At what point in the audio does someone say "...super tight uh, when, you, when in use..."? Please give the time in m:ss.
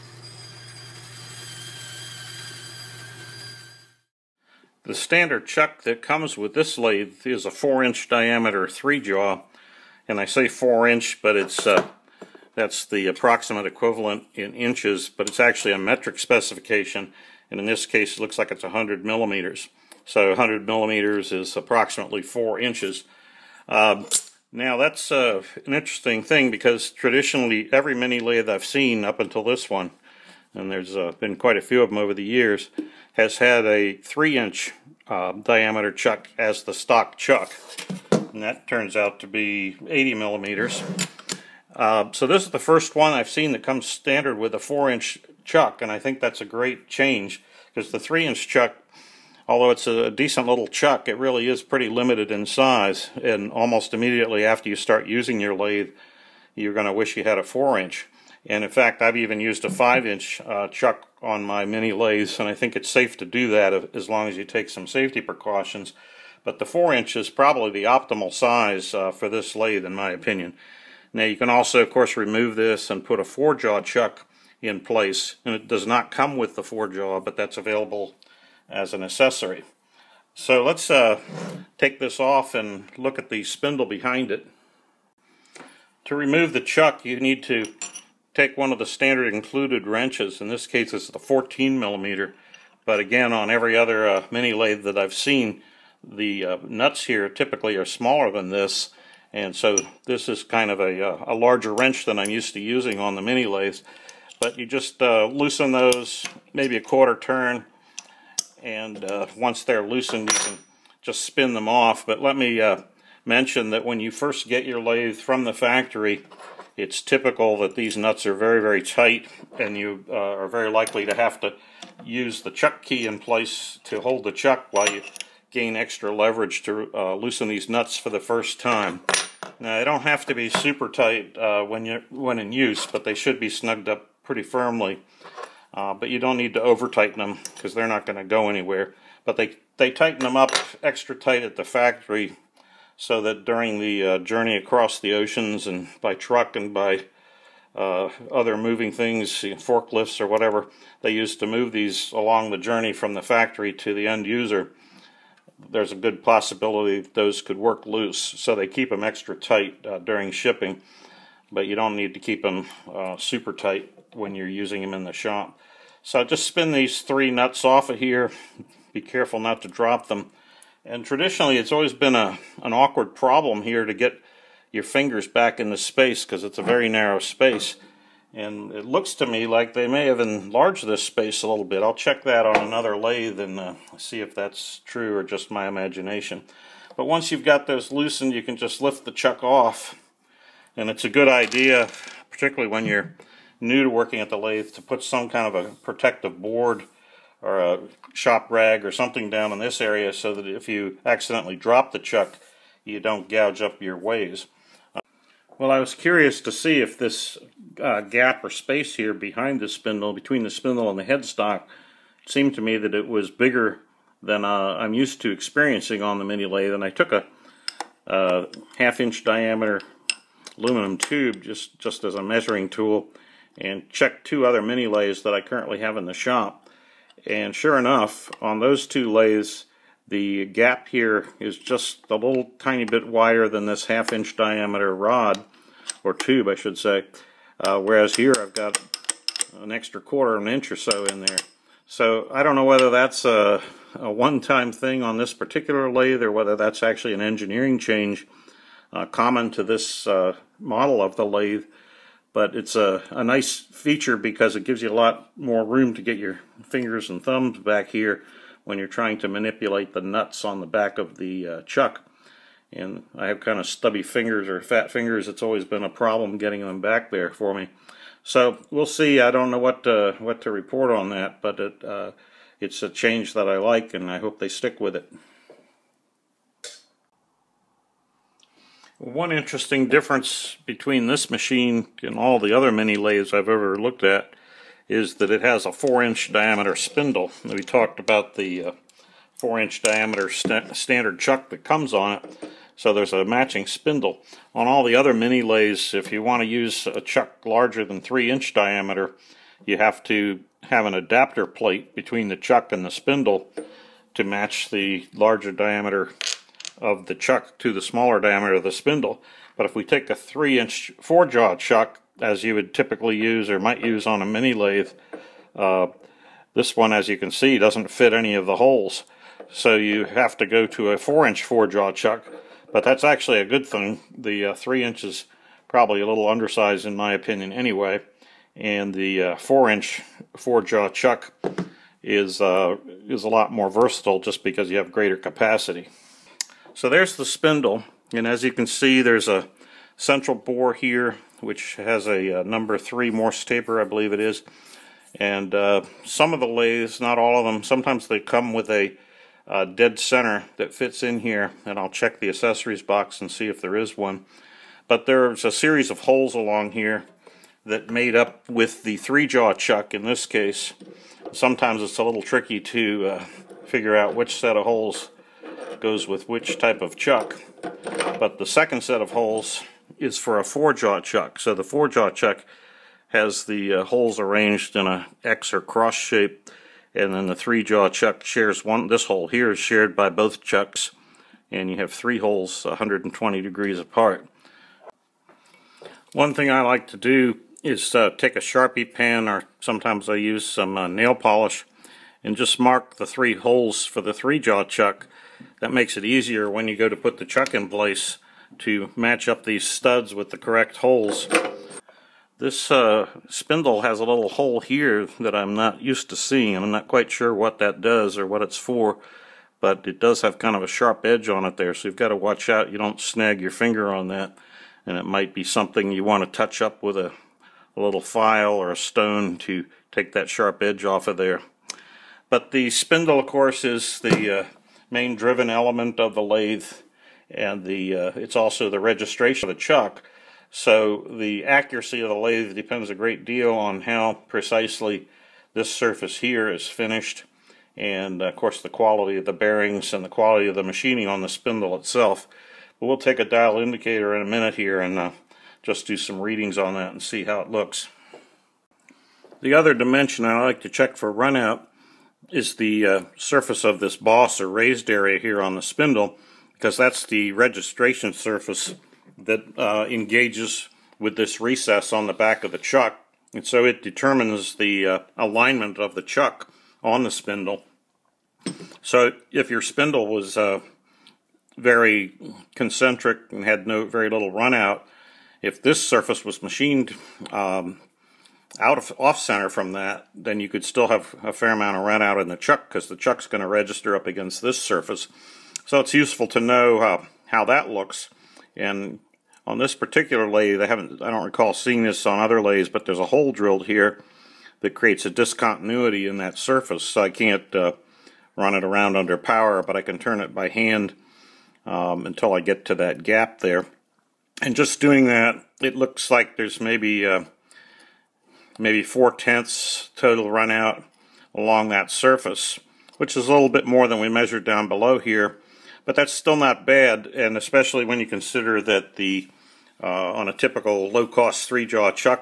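2:10.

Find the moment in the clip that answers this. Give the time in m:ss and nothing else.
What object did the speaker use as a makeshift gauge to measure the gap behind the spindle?
3:40.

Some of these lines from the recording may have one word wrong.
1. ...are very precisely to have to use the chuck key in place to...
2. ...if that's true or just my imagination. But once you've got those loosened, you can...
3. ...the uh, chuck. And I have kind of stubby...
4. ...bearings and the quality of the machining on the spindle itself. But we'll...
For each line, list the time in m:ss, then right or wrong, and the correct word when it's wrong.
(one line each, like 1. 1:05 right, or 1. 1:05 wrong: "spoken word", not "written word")
1. 2:00 wrong: "likely", not "precisely"
2. 3:04 right
3. 4:21 right
4. 7:19 right.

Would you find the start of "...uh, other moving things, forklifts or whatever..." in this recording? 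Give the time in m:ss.
2:27.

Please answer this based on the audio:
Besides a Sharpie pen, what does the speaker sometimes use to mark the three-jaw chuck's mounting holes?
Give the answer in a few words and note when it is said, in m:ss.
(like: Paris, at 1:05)
nail polish, at 6:30.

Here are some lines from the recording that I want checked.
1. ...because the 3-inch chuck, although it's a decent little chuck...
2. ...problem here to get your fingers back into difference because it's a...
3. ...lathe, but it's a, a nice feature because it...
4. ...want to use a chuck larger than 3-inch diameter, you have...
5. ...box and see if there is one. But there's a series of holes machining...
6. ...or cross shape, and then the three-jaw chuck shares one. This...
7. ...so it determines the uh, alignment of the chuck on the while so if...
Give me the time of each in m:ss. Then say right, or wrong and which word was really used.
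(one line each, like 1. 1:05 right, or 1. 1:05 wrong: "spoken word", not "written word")
1. 0:47 right
2. 2:53 wrong: "space", not "difference"
3. 4:11 right
4. 4:56 right
5. 5:52 wrong: "along", not "machining"
6. 6:15 right
7. 7:43 wrong: "spindle", not "while".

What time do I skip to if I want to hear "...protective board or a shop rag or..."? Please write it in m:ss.
3:15.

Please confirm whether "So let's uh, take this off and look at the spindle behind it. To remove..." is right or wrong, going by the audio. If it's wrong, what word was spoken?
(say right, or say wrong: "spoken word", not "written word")
right.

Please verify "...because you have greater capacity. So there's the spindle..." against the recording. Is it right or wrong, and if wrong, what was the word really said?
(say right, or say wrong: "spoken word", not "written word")
right.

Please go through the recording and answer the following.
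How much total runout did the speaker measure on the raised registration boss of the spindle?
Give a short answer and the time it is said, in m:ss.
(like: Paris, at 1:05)
4 tenths, at 8:28.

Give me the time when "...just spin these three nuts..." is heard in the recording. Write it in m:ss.
2:46.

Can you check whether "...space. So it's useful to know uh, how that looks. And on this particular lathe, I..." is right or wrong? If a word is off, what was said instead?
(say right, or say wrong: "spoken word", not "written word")
wrong: "surface", not "space".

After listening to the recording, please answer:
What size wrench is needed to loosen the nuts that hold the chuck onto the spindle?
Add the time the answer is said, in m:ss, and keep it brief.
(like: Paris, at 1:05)
14 millimeter, at 1:31.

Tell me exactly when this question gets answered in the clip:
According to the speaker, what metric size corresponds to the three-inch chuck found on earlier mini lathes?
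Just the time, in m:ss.
0:39.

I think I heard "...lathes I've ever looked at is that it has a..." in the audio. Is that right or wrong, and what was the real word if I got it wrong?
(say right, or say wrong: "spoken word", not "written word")
right.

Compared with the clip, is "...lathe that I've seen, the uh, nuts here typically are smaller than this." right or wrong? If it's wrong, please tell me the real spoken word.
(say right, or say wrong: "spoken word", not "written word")
right.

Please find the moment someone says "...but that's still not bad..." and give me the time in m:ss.
8:35.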